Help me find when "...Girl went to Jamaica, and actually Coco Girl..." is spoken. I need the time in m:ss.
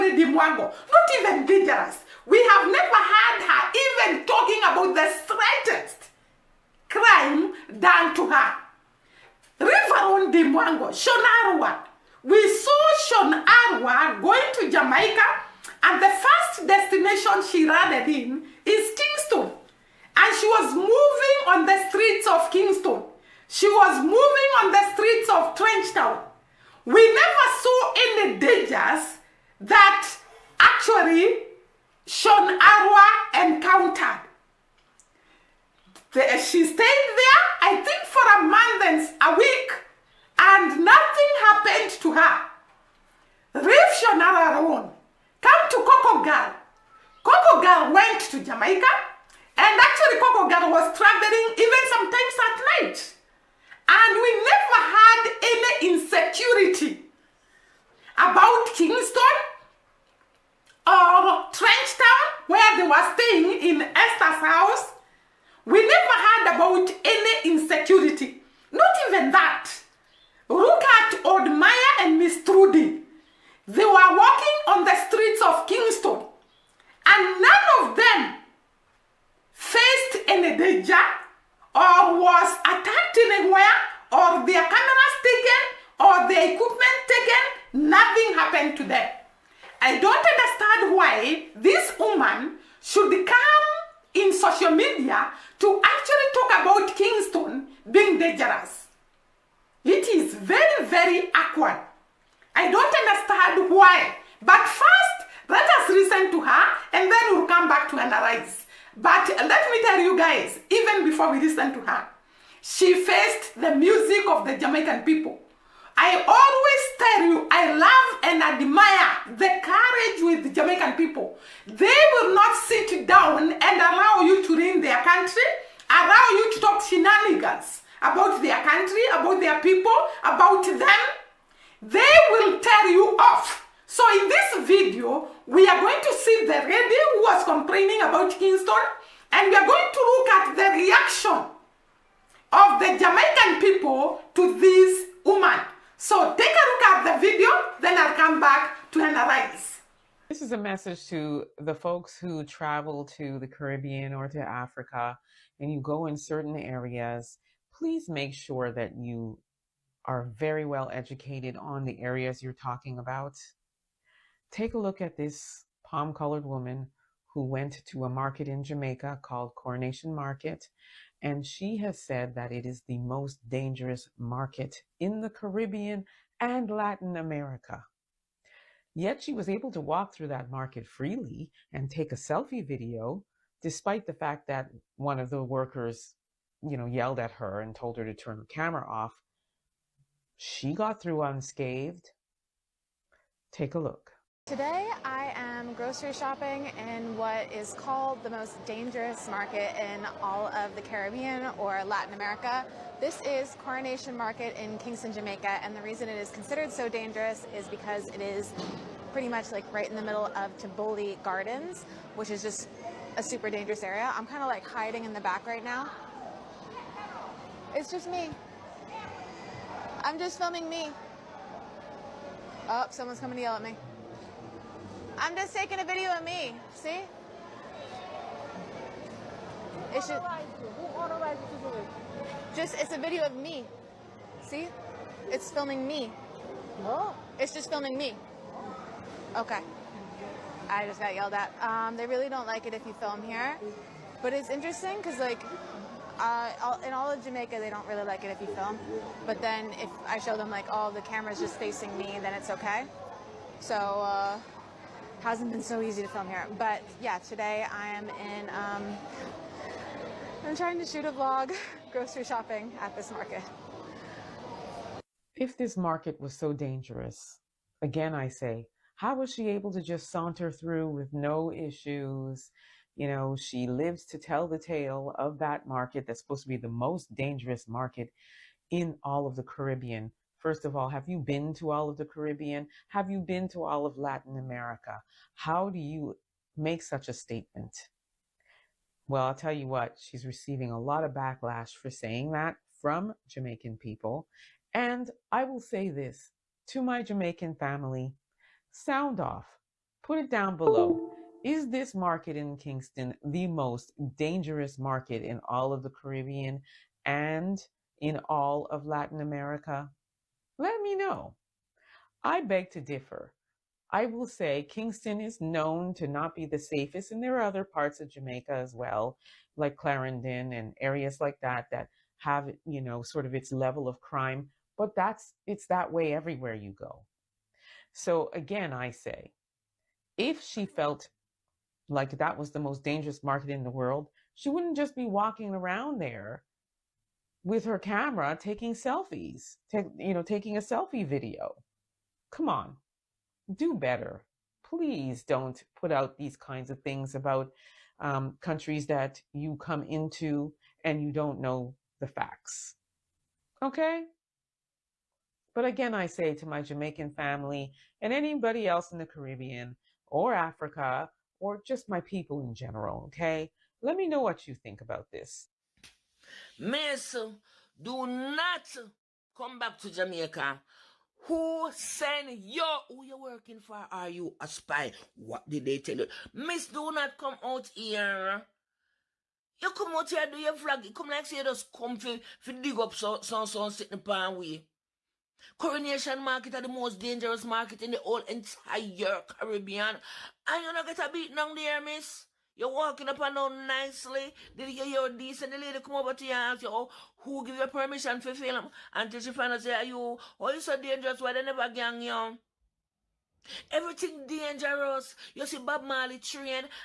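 0:47.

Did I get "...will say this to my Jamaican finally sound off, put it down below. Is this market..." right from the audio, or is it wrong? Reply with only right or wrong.
wrong.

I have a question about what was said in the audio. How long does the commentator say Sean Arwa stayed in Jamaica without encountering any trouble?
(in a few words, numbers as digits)
a month and a week.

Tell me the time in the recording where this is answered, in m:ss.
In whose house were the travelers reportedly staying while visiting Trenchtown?
1:03.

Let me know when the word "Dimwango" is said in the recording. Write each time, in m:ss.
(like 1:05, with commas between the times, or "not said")
0:00, 0:10.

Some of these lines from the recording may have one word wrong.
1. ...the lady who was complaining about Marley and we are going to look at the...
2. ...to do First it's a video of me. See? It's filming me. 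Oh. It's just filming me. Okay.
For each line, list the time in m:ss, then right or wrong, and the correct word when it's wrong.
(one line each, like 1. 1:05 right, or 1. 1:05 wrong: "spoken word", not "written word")
1. 2:16 wrong: "Kingston", not "Marley"
2. 3:51 wrong: "Just", not "First".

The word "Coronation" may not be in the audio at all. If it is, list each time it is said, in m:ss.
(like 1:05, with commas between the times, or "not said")
2:49, 3:23, 6:25.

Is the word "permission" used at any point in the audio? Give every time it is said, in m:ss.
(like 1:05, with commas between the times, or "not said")
6:37.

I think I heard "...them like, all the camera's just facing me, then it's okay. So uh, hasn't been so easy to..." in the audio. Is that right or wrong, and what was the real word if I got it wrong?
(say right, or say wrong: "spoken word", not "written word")
right.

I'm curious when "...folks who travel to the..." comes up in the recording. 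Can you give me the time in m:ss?
2:31.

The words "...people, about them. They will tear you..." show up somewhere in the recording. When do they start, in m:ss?
2:09.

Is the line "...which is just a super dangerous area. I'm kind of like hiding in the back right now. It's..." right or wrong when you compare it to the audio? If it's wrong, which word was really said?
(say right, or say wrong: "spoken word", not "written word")
right.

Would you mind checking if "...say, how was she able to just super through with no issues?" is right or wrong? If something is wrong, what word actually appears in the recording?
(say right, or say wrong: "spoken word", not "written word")
wrong: "saunter", not "super".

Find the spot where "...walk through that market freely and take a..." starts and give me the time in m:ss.
2:59.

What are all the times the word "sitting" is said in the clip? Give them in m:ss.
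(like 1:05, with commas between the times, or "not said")
6:23.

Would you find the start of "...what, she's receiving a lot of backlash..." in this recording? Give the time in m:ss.
4:49.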